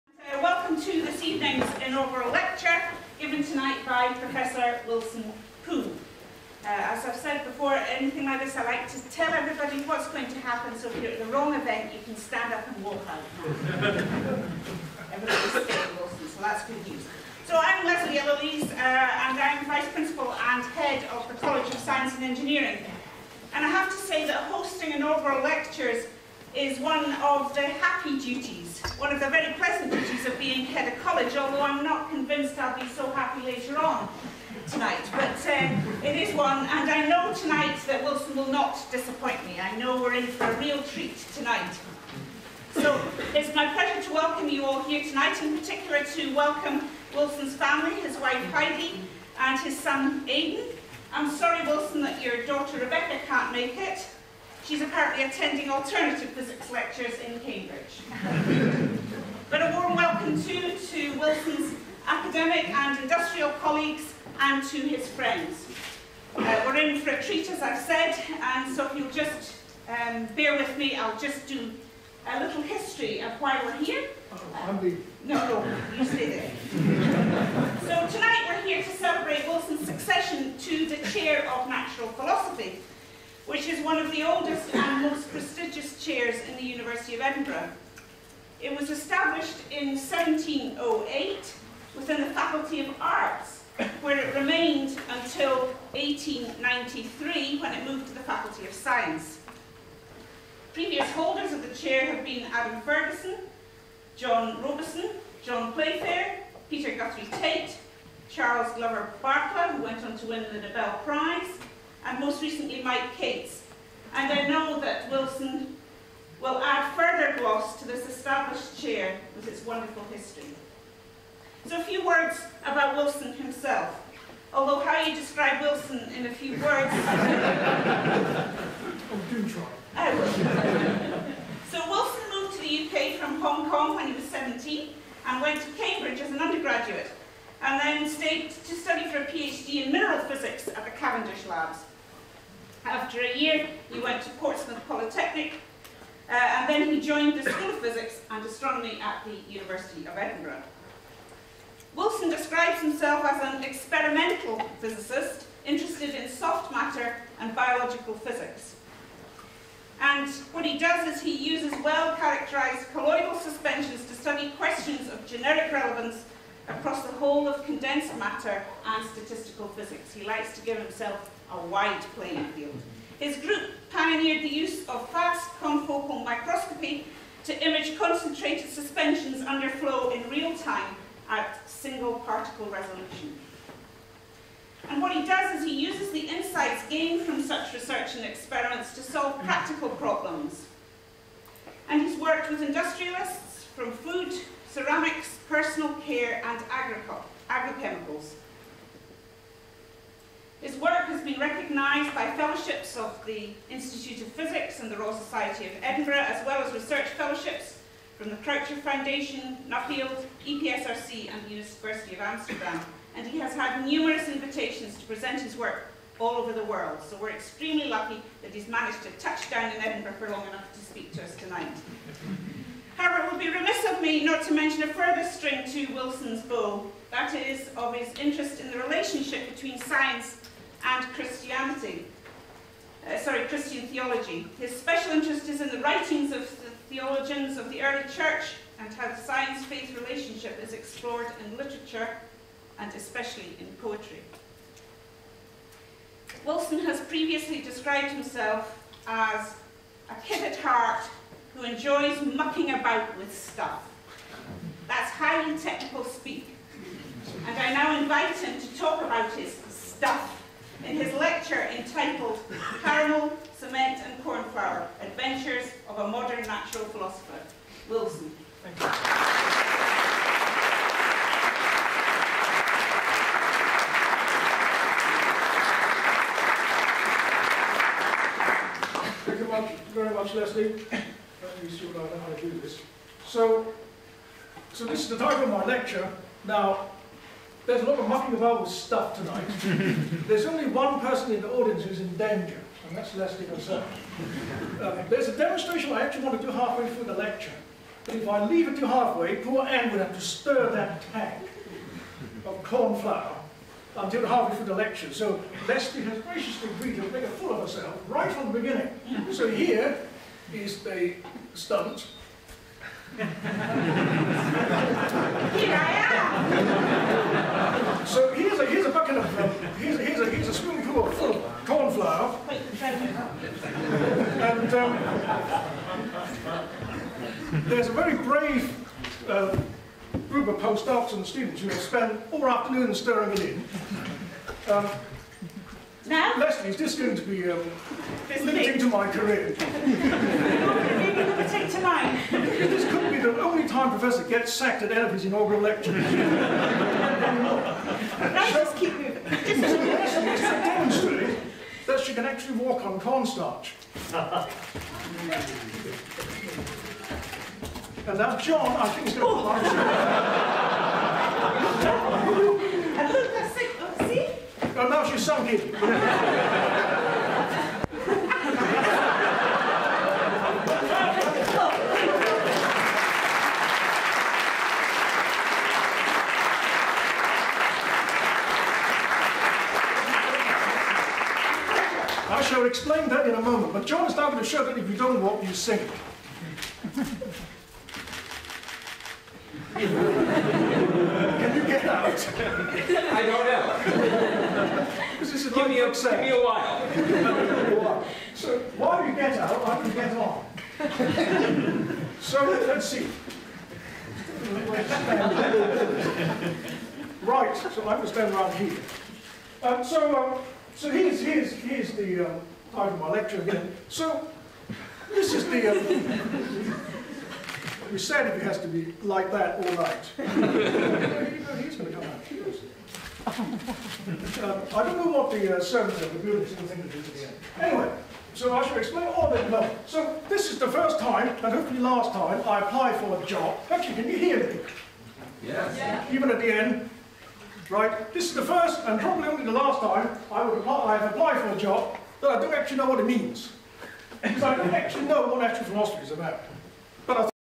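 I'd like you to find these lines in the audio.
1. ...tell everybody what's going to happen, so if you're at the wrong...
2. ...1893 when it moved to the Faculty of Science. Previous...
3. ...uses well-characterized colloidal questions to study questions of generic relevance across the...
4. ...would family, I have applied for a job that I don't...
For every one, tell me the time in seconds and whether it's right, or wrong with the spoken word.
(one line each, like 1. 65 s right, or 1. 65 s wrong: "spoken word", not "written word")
1. 9 s right
2. 95 s right
3. 161 s wrong: "suspensions", not "questions"
4. 440 s wrong: "apply", not "family".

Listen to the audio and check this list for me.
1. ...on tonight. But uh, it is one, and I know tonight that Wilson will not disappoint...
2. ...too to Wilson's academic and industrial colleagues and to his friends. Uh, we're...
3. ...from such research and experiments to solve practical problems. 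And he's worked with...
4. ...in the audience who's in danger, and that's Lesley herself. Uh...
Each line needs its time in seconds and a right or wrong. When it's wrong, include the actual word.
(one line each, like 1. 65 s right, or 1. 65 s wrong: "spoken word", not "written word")
1. 33 s right
2. 60 s right
3. 187 s right
4. 291 s right.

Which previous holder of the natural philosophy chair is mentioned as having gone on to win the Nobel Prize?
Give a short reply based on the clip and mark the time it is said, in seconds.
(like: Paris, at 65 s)
Charles Glover Barkla, at 108 s.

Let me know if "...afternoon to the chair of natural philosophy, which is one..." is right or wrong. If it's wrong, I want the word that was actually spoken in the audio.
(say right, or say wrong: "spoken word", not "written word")
wrong: "succession", not "afternoon".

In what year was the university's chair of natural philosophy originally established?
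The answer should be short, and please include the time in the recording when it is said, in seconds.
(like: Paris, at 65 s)
1708, at 89 s.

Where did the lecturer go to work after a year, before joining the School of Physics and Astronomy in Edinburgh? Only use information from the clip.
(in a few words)
Portsmouth Polytechnic.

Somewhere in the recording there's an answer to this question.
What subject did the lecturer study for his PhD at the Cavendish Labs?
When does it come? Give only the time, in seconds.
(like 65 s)
139 s.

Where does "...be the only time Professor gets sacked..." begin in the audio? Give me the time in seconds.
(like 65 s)
343 s.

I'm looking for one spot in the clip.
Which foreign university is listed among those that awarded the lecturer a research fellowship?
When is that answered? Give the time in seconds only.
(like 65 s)
211 s.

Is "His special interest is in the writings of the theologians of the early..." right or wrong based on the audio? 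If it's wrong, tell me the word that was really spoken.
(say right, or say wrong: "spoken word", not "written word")
right.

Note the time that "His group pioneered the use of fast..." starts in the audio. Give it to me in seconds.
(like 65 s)
173 s.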